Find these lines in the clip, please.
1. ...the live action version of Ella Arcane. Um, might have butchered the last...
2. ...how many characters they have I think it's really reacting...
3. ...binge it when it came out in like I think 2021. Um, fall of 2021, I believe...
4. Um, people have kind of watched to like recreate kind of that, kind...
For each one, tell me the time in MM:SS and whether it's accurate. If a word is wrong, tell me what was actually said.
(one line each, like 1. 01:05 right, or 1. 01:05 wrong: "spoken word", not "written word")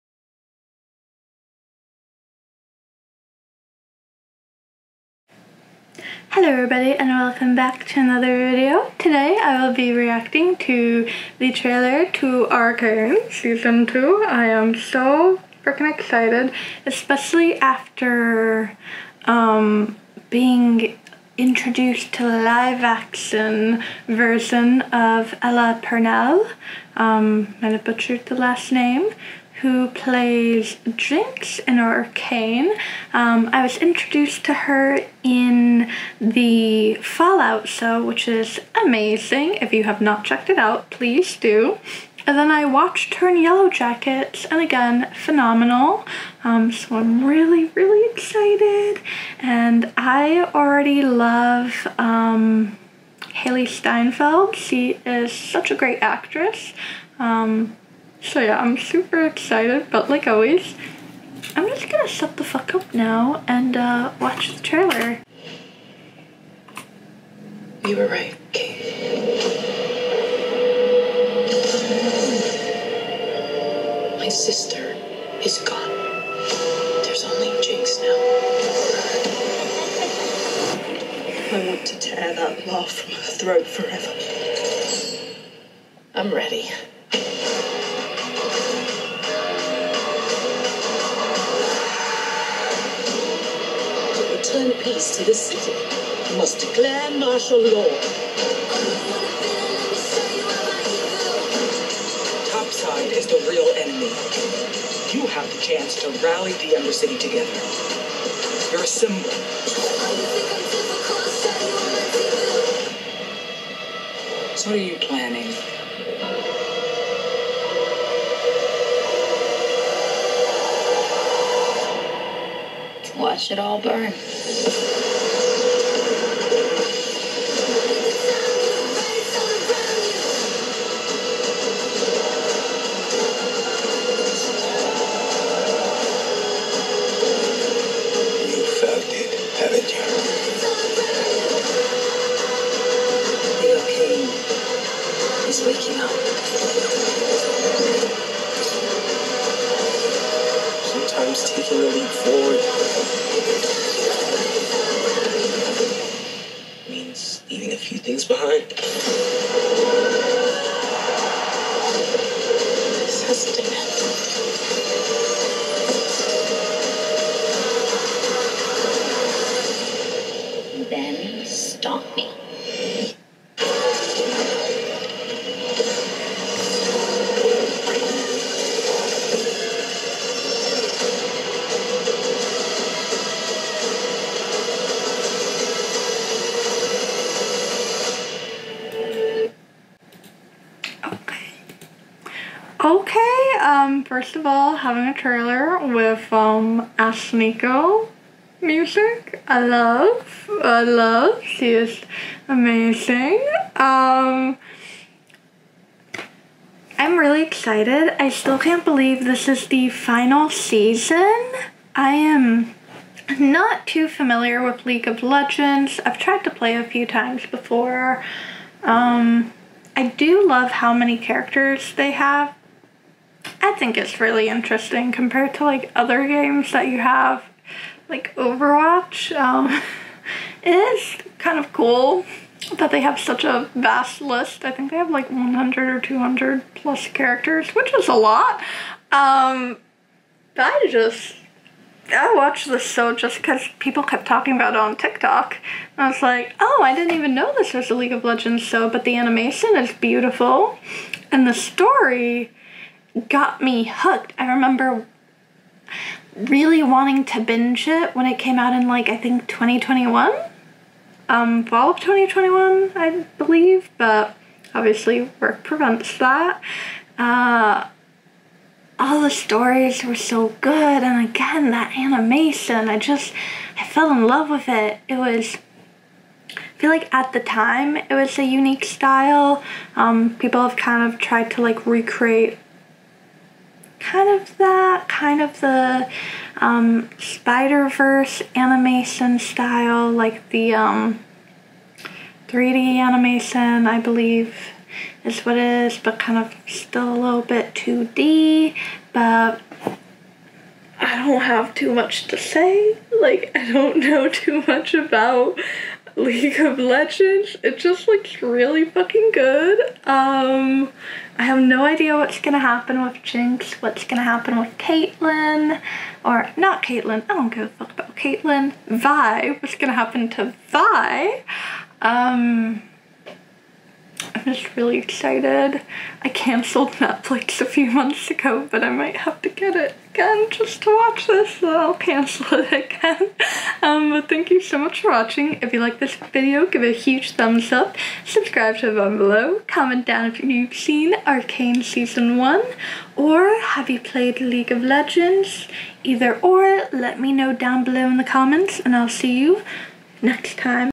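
1. 00:22 wrong: "Purnell", not "Arcane"
2. 03:40 wrong: "interesting", not "reacting"
3. 04:17 right
4. 04:39 wrong: "tried", not "watched".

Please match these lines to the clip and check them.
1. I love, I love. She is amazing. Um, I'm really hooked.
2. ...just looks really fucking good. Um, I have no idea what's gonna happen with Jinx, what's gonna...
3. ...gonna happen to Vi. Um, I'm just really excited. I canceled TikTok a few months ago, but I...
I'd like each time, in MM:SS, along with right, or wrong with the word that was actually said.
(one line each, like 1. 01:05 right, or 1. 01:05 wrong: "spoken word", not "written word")
1. 03:19 wrong: "excited", not "hooked"
2. 05:07 right
3. 05:19 wrong: "Netflix", not "TikTok".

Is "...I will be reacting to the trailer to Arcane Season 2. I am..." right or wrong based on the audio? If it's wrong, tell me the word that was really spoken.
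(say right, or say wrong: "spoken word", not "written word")
right.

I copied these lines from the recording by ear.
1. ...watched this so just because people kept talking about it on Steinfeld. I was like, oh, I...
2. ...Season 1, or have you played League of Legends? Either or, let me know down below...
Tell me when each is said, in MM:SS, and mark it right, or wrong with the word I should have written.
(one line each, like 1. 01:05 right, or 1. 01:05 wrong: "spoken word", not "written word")
1. 04:02 wrong: "TikTok", not "Steinfeld"
2. 05:41 right.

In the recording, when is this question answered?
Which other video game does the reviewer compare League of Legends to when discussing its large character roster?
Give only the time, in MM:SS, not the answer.
03:48.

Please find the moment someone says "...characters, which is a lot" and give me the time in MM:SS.
03:57.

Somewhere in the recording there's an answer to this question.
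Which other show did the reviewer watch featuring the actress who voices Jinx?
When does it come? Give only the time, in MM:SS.
00:43.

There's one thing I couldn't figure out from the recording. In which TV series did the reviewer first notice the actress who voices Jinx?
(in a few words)
Fallout.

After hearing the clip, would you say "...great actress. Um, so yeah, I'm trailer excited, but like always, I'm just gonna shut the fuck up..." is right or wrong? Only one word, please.
wrong.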